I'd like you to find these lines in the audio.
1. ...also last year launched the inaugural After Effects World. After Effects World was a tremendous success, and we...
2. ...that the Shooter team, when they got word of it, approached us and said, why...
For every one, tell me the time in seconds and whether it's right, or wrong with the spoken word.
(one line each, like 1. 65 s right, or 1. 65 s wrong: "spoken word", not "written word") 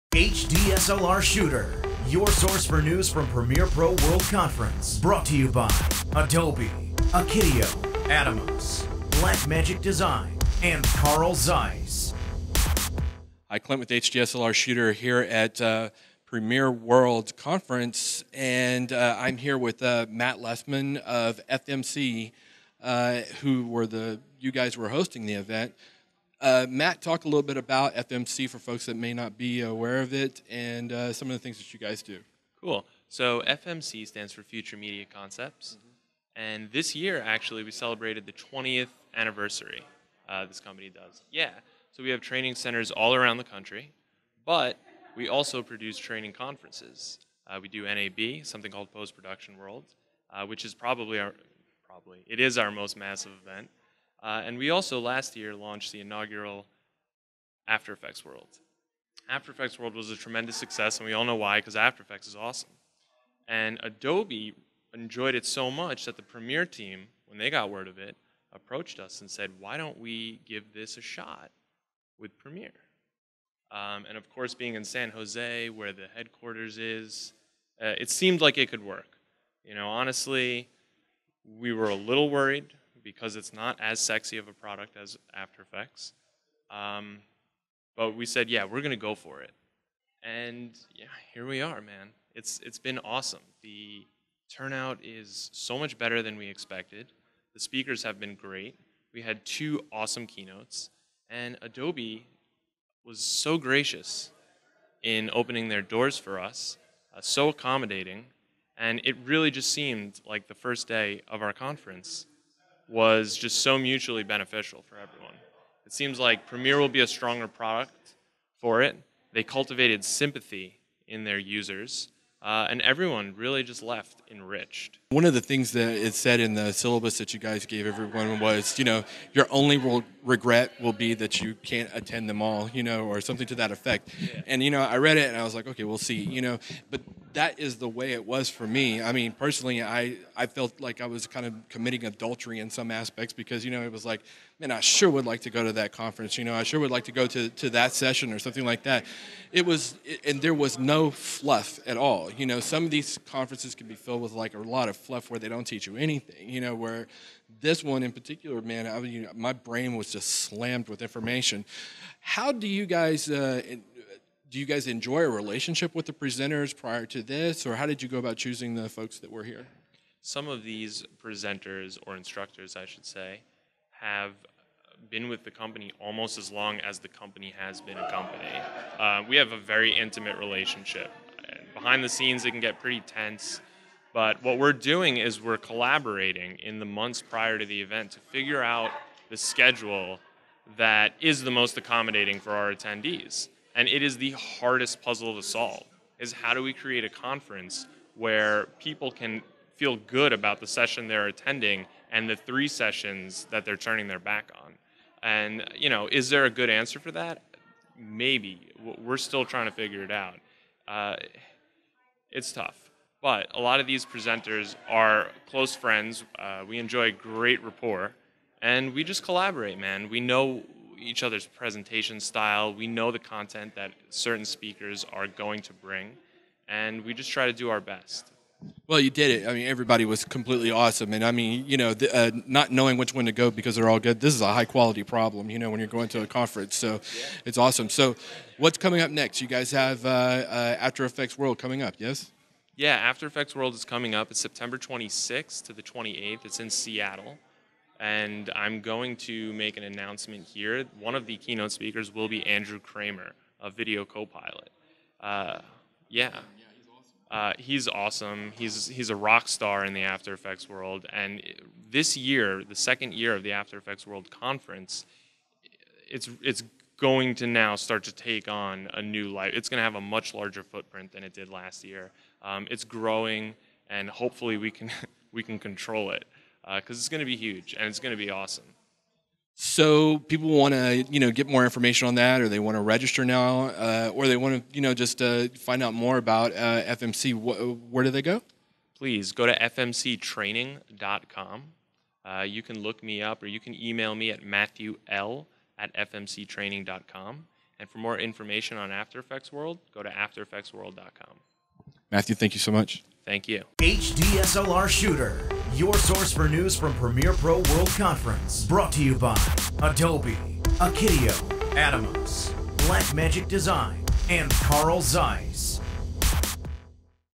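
1. 54 s right
2. 66 s wrong: "Premiere", not "Shooter".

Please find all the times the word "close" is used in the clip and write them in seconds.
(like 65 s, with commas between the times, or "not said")
215 s.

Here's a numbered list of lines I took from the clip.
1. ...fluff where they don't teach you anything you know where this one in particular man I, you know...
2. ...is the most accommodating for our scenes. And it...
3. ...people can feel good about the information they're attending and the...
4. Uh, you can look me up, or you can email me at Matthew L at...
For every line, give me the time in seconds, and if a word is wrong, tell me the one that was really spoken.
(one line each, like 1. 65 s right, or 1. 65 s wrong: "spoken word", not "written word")
1. 154 s right
2. 191 s wrong: "attendees", not "scenes"
3. 198 s wrong: "session", not "information"
4. 292 s right.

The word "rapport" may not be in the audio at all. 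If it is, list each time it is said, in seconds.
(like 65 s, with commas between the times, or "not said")
217 s.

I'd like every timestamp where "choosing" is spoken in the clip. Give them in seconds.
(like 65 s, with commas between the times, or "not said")
168 s.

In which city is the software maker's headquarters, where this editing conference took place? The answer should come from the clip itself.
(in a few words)
San Jose.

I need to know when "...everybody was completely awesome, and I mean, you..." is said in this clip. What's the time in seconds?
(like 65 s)
229 s.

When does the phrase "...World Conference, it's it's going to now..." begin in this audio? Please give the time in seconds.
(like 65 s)
264 s.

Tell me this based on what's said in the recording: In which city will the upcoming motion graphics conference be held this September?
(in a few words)
Seattle.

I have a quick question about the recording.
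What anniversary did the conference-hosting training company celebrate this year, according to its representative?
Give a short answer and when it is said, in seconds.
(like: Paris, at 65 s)
20th, at 38 s.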